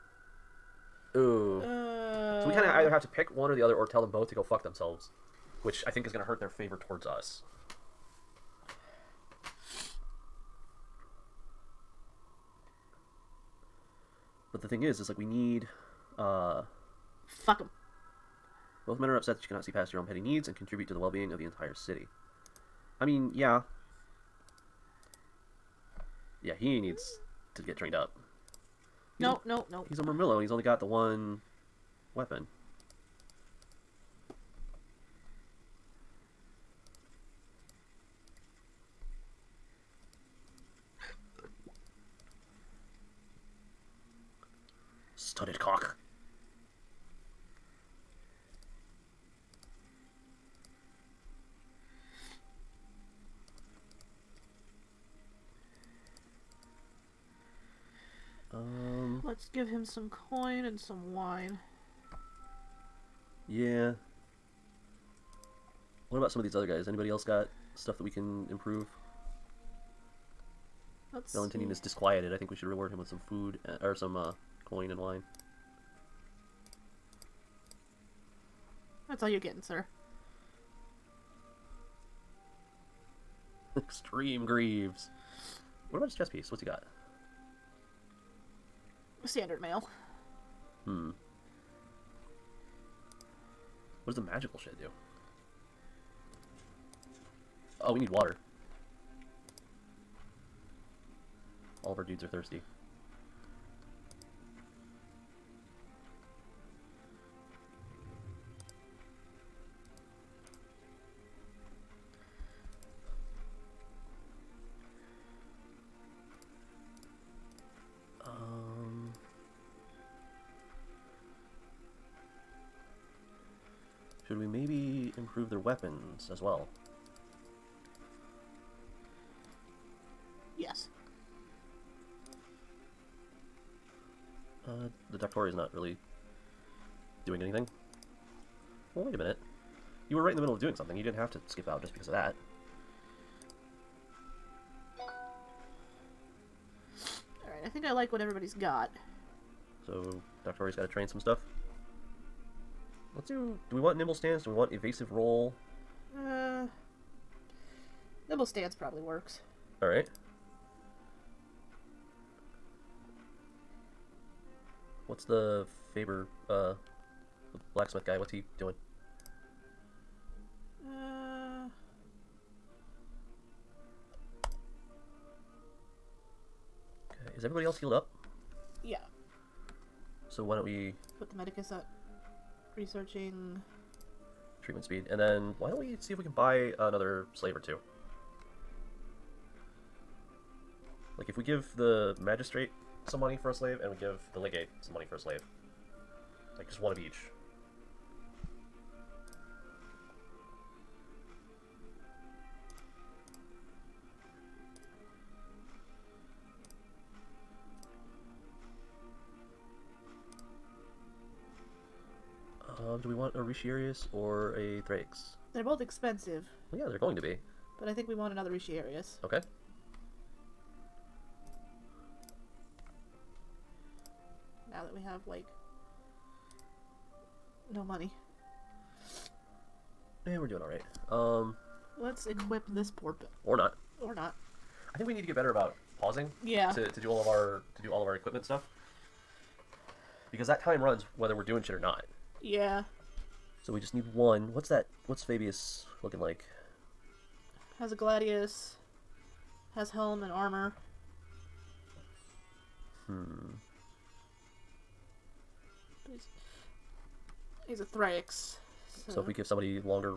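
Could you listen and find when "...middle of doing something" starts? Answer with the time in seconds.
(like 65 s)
140 s.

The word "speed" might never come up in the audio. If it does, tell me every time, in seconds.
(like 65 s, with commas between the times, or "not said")
184 s.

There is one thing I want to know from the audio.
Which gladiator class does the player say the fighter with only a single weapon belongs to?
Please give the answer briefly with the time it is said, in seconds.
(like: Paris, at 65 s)
Murmillo, at 30 s.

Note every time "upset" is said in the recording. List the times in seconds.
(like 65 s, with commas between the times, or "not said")
19 s.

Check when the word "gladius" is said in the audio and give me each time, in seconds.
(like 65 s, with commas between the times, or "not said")
247 s.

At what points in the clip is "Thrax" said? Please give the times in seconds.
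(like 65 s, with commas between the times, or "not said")
214 s, 257 s.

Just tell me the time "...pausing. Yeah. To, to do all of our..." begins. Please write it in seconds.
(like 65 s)
235 s.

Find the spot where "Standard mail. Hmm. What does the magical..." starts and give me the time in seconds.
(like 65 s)
89 s.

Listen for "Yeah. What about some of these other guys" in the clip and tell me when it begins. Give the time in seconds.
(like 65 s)
63 s.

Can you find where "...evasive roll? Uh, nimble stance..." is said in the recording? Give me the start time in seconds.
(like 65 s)
154 s.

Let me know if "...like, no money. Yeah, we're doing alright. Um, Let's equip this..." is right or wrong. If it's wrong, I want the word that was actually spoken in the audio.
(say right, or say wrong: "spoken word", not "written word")
right.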